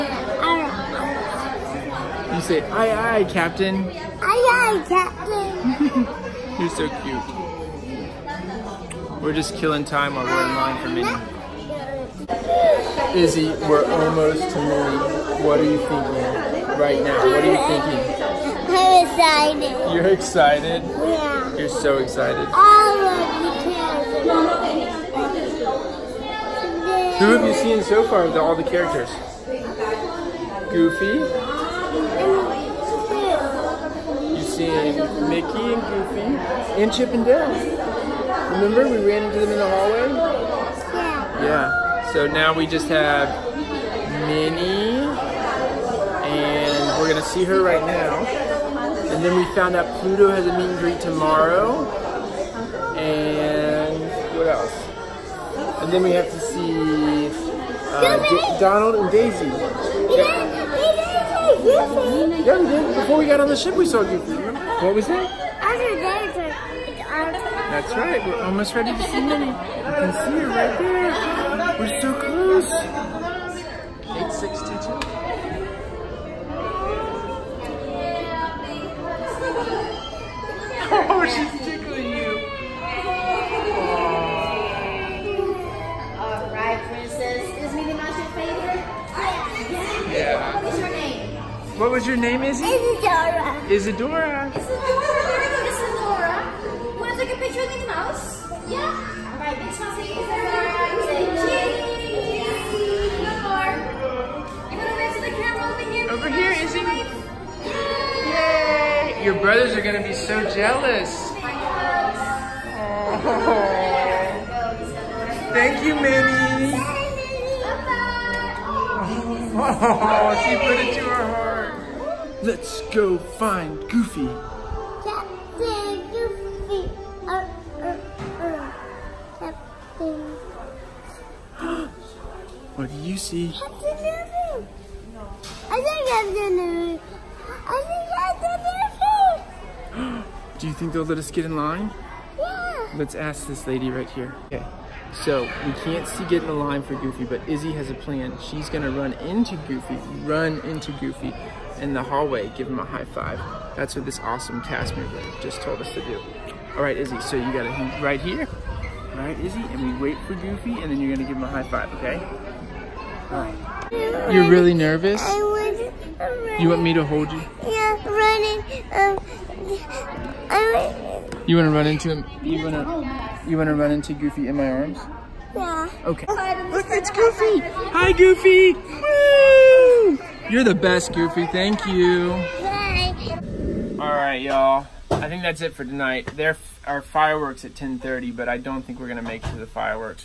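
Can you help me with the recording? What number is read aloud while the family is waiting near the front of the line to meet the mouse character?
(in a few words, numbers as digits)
862.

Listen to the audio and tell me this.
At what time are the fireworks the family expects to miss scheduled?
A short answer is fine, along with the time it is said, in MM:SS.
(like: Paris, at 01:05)
10:30, at 03:07.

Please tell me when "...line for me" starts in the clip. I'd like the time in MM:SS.
00:10.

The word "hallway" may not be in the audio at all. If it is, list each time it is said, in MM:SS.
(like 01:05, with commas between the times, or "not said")
00:39, 02:32.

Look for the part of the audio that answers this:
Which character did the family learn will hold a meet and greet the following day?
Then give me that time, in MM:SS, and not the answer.
00:50.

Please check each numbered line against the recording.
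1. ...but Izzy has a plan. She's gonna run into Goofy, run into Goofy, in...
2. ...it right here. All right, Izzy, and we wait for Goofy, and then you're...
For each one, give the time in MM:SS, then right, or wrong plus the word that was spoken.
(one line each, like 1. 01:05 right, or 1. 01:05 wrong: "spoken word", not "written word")
1. 02:27 right
2. 02:37 right.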